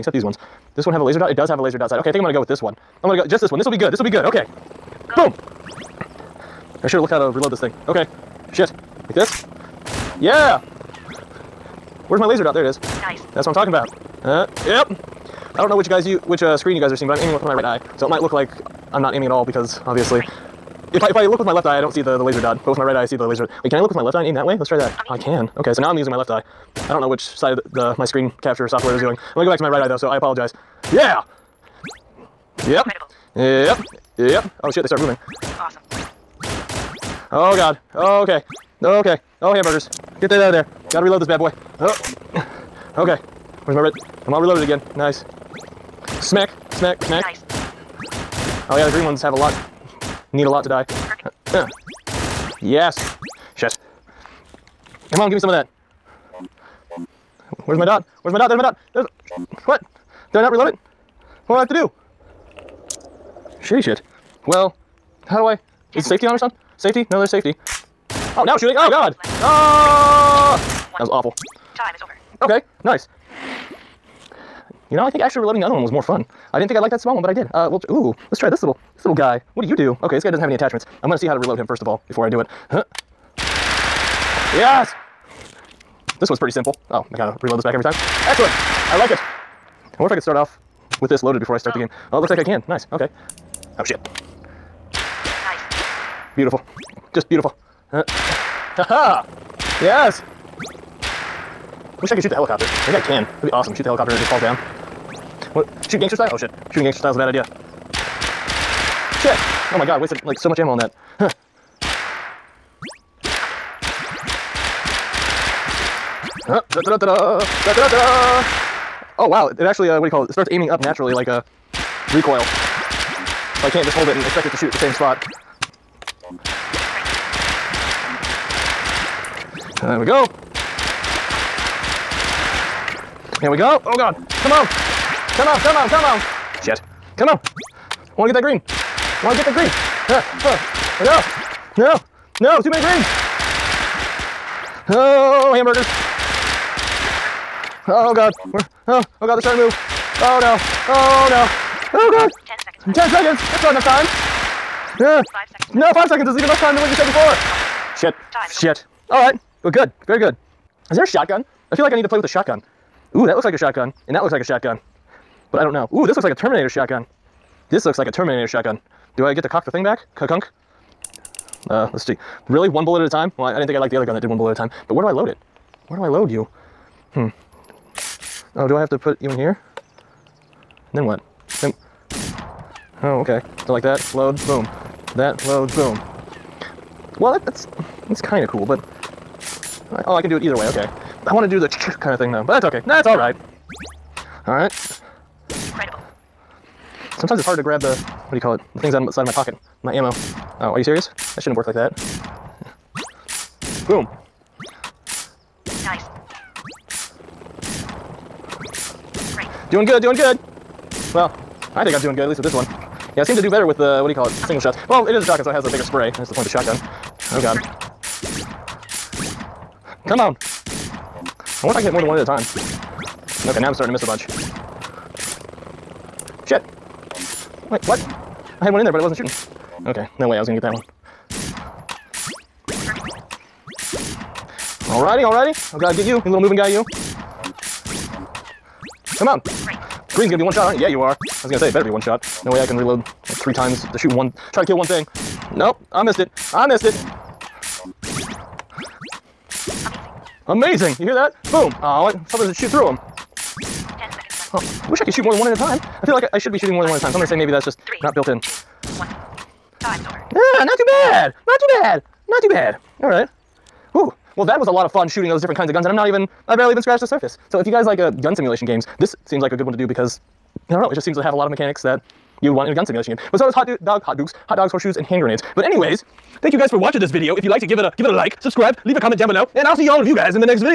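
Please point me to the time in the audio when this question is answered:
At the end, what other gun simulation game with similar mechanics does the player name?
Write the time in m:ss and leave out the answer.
4:34.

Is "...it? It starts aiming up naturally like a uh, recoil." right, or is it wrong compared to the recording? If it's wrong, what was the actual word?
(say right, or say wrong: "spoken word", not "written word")
right.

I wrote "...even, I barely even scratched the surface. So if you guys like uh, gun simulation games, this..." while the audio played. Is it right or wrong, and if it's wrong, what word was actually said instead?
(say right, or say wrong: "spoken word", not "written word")
right.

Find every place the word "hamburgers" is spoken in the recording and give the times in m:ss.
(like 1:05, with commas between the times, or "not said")
0:39, 2:25.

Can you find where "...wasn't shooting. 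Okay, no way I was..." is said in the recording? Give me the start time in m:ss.
3:49.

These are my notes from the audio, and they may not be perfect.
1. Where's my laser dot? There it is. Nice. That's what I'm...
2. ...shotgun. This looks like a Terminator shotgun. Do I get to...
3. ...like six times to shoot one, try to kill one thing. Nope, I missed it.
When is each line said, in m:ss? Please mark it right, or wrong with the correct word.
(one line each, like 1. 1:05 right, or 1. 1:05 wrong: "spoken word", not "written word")
1. 0:12 right
2. 2:46 right
3. 4:02 wrong: "three", not "six".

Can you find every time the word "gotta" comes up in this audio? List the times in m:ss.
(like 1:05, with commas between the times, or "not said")
0:40, 1:27.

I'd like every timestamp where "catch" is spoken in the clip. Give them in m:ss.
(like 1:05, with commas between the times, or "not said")
not said.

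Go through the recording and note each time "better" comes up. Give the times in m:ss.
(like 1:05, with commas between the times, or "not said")
3:33, 4:01.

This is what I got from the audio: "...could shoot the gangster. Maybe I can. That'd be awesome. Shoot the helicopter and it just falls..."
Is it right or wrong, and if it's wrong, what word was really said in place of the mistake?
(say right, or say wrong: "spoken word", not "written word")
wrong: "helicopter", not "gangster".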